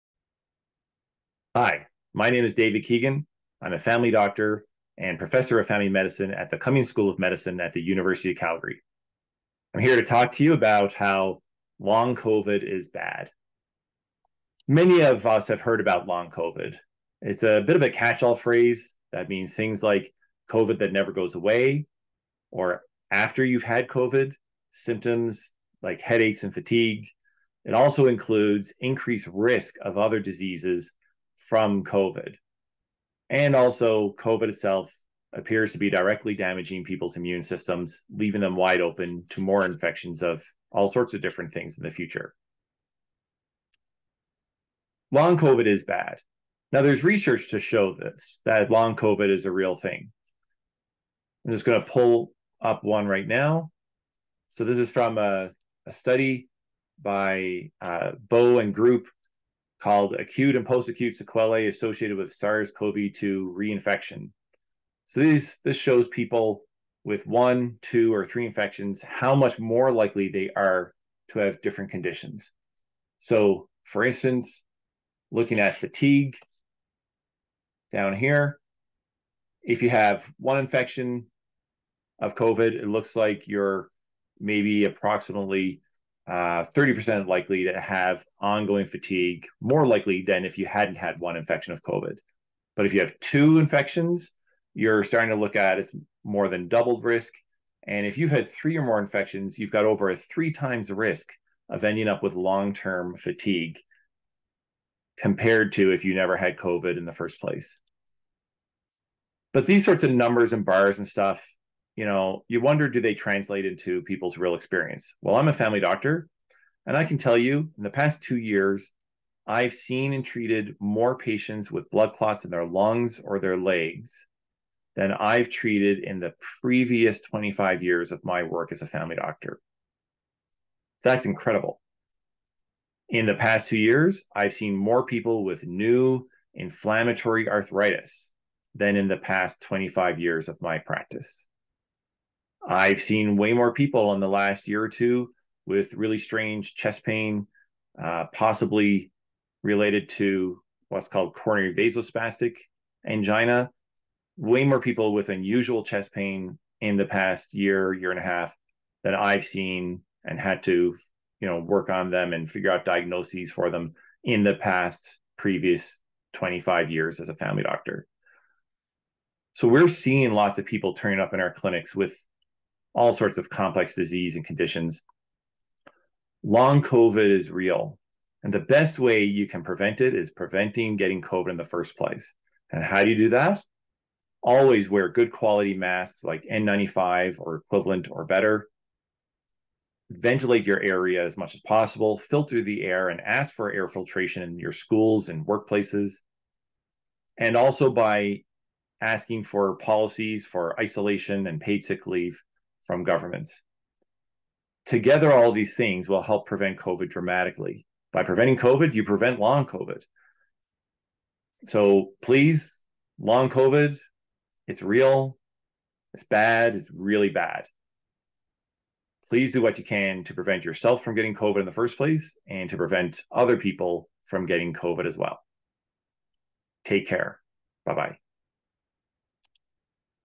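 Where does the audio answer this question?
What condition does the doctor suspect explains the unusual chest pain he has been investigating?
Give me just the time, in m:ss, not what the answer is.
2:31.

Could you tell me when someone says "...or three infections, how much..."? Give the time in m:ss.
1:08.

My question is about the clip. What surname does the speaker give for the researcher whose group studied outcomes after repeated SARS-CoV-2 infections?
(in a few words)
Bowe.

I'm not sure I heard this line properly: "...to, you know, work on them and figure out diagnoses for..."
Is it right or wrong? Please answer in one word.
right.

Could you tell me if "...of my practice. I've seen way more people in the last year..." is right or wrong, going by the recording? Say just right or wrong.
right.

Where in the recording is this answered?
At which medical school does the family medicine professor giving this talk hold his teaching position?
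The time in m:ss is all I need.
0:06.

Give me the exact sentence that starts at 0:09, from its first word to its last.
I'm here to talk to you about how long COVID is bad.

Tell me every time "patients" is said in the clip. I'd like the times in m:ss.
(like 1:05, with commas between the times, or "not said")
2:01.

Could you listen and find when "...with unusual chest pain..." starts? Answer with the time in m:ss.
2:35.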